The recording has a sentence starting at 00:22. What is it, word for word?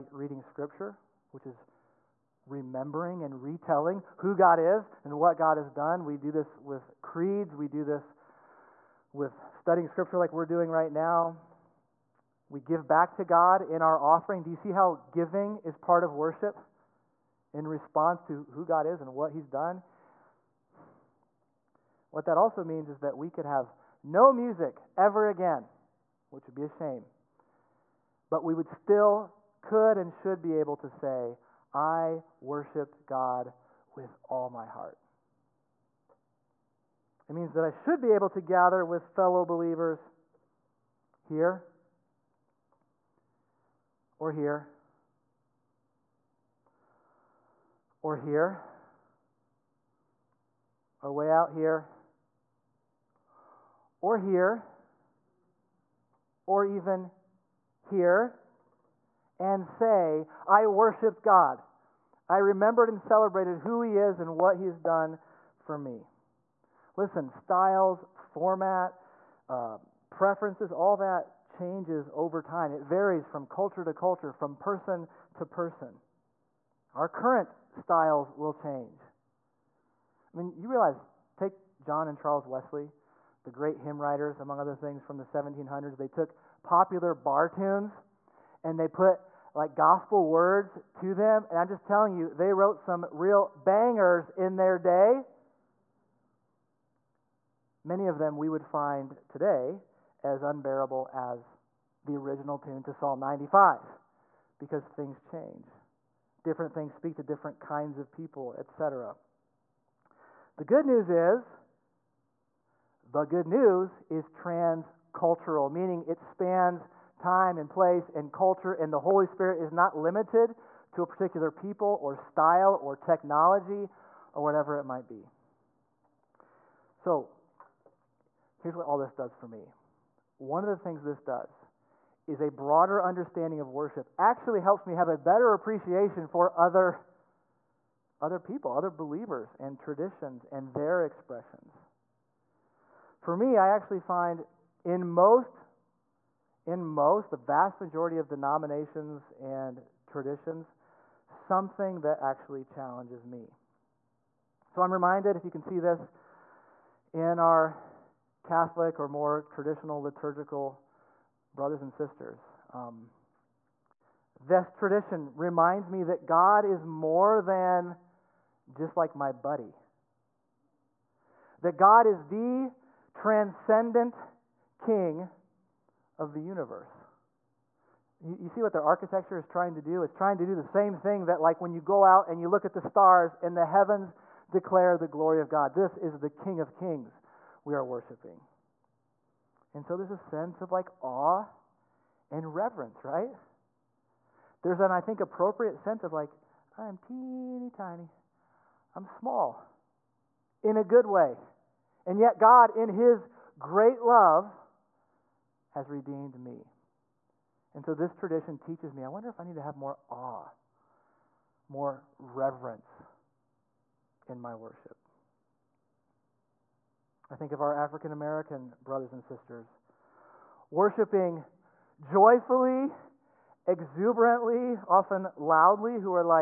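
What that also means is that we could have no music ever again, which would be a shame.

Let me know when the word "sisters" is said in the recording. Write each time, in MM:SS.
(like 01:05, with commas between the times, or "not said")
02:41, 03:39.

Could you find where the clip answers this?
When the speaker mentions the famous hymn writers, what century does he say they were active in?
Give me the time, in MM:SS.
01:25.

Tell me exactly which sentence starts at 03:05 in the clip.
This is the King of Kings we are worshiping.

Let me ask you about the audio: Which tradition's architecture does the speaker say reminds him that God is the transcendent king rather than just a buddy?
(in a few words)
Catholic.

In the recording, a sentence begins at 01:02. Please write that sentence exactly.
I remembered and celebrated who He is and what He's done for me.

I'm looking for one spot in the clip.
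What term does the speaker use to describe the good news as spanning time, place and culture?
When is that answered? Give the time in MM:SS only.
01:54.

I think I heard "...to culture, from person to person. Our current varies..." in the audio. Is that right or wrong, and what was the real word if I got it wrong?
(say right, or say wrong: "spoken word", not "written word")
wrong: "styles", not "varies".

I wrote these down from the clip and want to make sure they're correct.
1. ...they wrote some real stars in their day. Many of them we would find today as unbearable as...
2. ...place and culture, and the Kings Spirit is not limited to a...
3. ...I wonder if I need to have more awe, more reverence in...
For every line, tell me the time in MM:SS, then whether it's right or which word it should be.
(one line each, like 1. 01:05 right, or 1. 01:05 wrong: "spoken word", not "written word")
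1. 01:32 wrong: "bangers", not "stars"
2. 01:57 wrong: "Holy", not "Kings"
3. 03:29 right.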